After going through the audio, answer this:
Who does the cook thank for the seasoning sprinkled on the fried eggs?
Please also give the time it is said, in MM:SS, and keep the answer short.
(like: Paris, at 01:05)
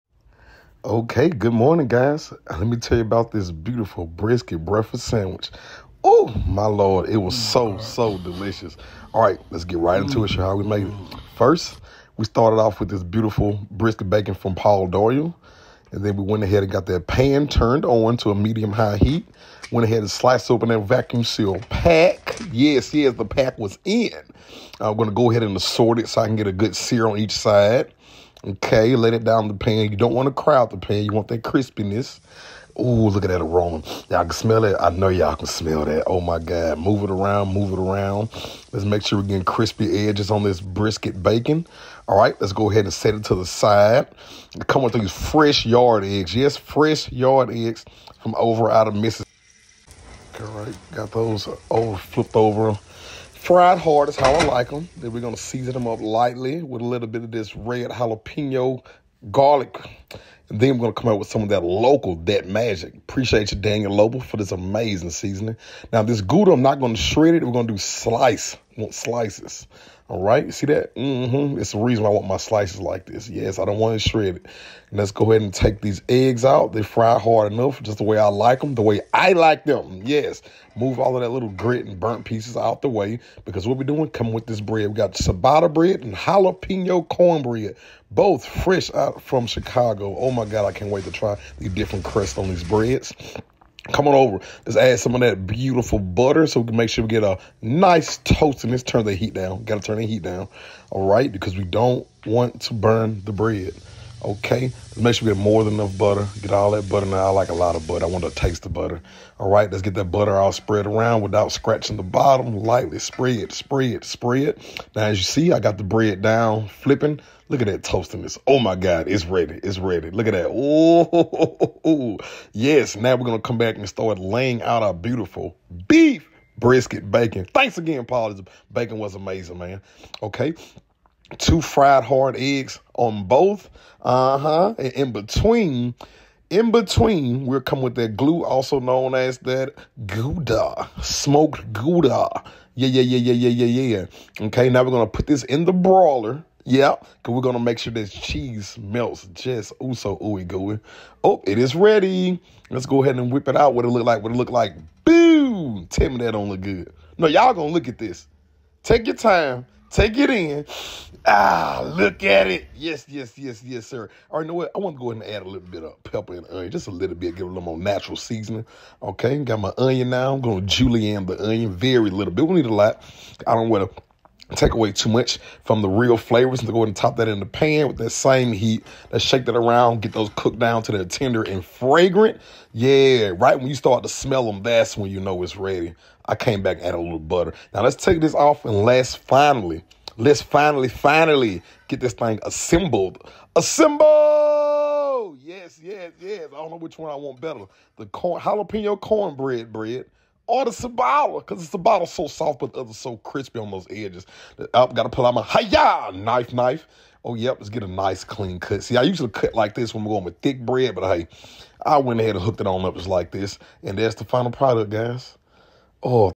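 Daniel Lobo, at 01:03.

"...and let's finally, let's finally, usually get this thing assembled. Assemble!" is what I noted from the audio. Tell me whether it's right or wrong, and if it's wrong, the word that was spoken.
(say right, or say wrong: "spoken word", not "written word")
wrong: "finally", not "usually".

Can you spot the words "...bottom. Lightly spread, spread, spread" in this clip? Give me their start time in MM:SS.
01:52.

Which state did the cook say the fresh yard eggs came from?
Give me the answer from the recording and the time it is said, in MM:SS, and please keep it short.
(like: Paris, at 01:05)
Mississippi, at 00:48.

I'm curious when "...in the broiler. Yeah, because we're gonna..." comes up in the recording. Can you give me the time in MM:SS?
02:25.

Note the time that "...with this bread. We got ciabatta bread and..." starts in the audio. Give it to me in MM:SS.
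01:24.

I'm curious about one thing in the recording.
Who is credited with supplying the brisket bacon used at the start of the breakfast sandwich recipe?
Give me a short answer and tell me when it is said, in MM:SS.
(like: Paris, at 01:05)
Paul Doyle, at 00:14.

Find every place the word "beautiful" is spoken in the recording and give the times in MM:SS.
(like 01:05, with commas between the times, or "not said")
00:03, 00:13, 01:35, 02:04.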